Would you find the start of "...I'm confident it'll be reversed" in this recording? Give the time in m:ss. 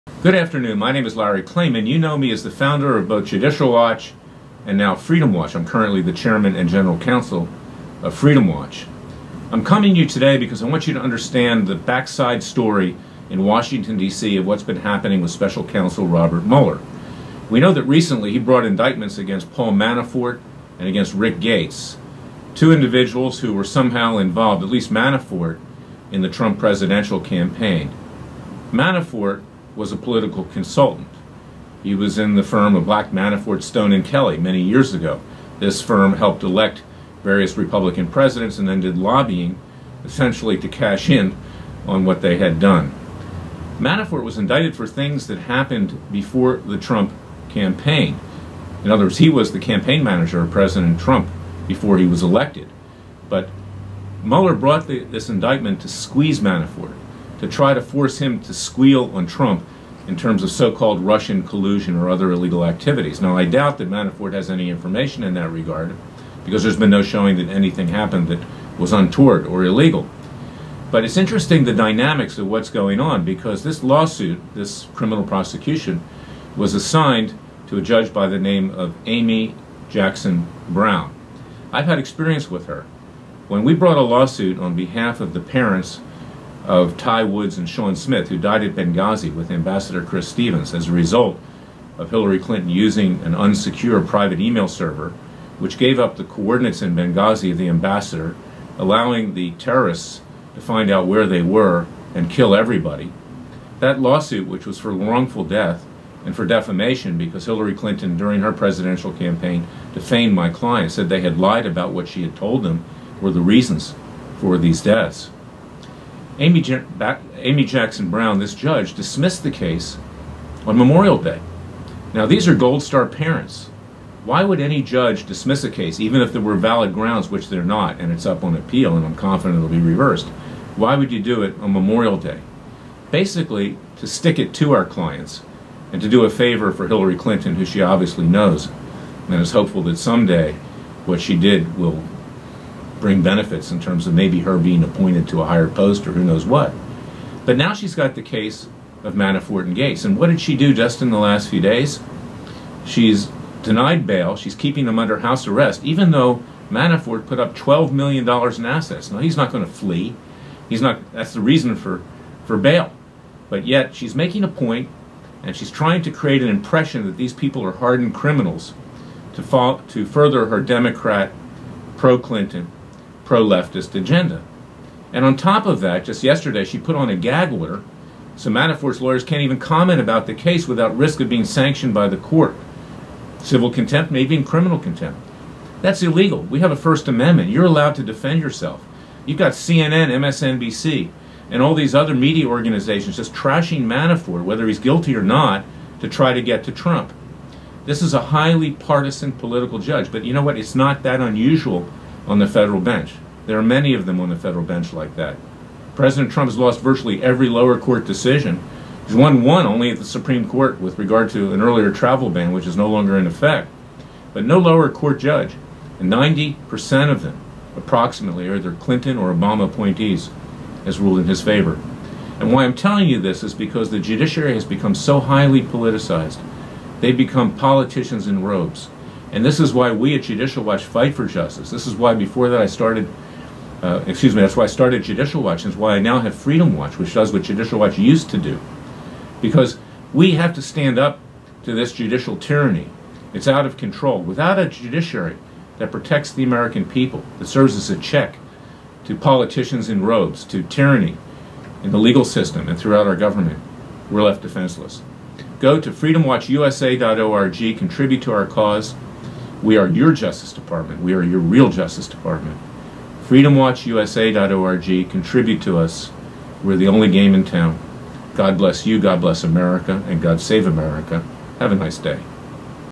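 2:09.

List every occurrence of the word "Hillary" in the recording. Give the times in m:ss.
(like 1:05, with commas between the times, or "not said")
1:32, 1:47, 2:16.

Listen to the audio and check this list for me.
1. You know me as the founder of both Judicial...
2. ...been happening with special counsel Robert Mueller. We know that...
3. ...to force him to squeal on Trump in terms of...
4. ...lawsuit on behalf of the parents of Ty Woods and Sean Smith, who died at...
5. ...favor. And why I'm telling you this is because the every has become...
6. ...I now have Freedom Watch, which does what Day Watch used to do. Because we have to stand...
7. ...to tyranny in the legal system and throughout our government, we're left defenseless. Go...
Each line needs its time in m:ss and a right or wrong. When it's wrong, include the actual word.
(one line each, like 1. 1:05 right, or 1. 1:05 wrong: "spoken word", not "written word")
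1. 0:01 right
2. 0:14 right
3. 0:57 right
4. 1:24 right
5. 3:41 wrong: "judiciary", not "every"
6. 3:55 wrong: "Judicial", not "Day"
7. 4:10 right.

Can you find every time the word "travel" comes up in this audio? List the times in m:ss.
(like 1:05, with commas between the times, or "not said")
3:31.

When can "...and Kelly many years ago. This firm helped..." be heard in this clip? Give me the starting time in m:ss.
0:33.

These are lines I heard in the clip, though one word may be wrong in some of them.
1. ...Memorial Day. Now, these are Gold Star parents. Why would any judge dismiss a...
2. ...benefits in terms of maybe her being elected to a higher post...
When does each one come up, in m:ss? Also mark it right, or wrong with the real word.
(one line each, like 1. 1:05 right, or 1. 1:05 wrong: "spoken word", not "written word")
1. 2:00 right
2. 2:23 wrong: "appointed", not "elected".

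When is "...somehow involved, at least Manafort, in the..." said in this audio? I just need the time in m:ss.
0:23.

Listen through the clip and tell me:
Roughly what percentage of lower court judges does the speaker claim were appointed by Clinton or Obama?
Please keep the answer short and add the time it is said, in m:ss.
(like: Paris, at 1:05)
90%, at 3:36.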